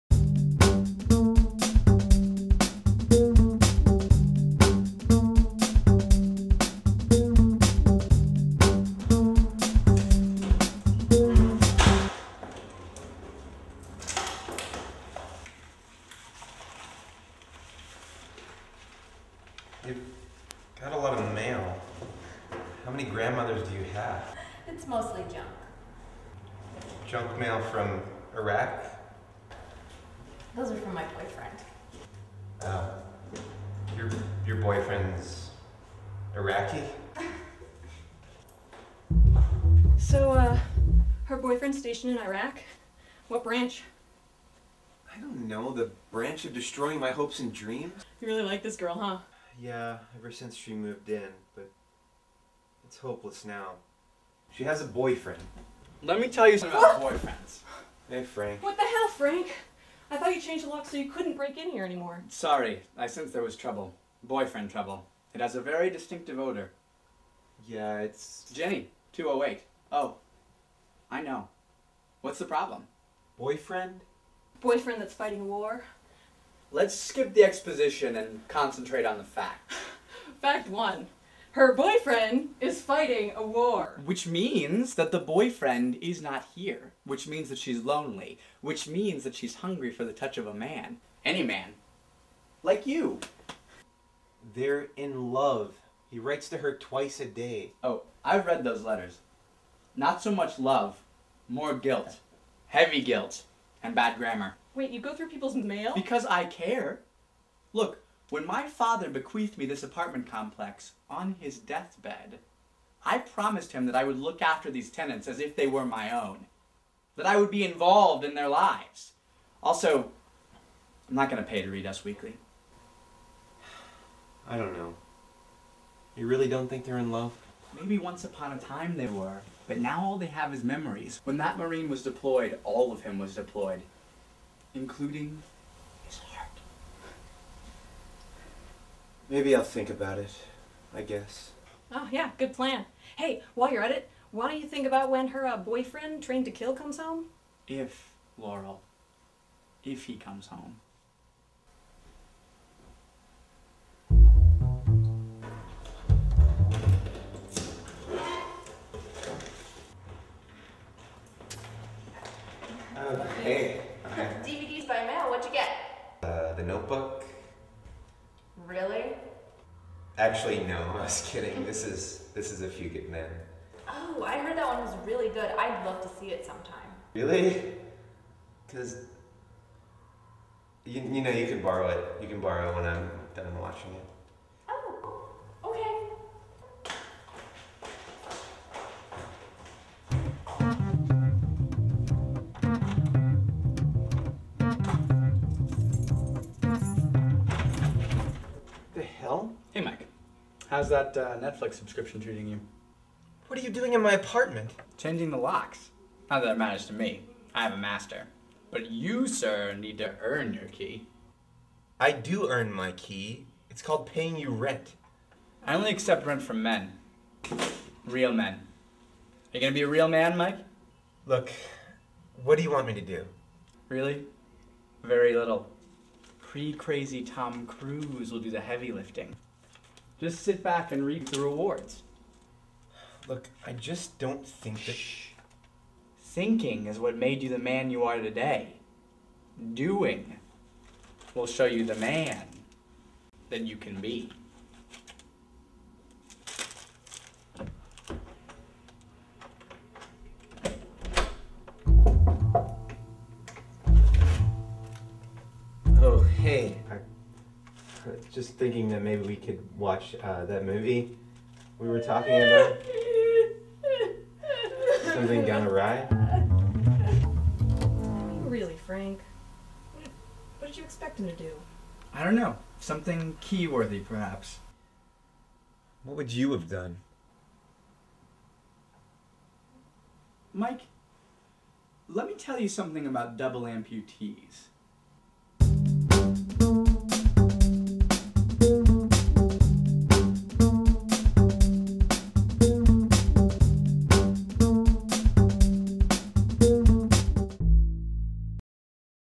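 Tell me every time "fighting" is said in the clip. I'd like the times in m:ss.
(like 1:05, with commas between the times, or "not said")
1:15, 1:22.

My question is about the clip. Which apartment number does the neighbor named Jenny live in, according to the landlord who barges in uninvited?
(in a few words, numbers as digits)
208.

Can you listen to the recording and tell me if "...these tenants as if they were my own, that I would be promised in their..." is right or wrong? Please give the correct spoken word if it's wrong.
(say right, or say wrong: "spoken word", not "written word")
wrong: "involved", not "promised".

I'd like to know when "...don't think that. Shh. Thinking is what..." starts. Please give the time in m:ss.
3:54.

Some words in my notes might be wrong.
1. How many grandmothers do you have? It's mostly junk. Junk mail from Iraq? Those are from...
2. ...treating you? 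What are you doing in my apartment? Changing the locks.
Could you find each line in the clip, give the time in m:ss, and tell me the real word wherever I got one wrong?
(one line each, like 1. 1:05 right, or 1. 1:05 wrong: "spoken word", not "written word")
1. 0:22 right
2. 3:22 right.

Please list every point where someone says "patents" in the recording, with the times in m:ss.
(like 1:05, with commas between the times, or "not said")
not said.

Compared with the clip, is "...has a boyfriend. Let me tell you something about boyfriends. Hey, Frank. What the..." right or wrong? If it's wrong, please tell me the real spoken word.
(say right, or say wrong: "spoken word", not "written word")
right.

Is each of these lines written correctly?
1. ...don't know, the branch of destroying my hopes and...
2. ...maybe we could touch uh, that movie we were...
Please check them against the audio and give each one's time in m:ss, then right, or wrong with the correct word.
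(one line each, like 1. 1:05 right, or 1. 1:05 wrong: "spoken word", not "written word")
1. 0:45 right
2. 4:19 wrong: "watch", not "touch".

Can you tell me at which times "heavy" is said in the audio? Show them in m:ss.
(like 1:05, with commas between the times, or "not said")
1:42, 3:48.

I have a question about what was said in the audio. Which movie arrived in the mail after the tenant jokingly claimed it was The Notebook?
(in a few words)
A Few Good Men.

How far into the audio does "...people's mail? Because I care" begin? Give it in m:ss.
1:45.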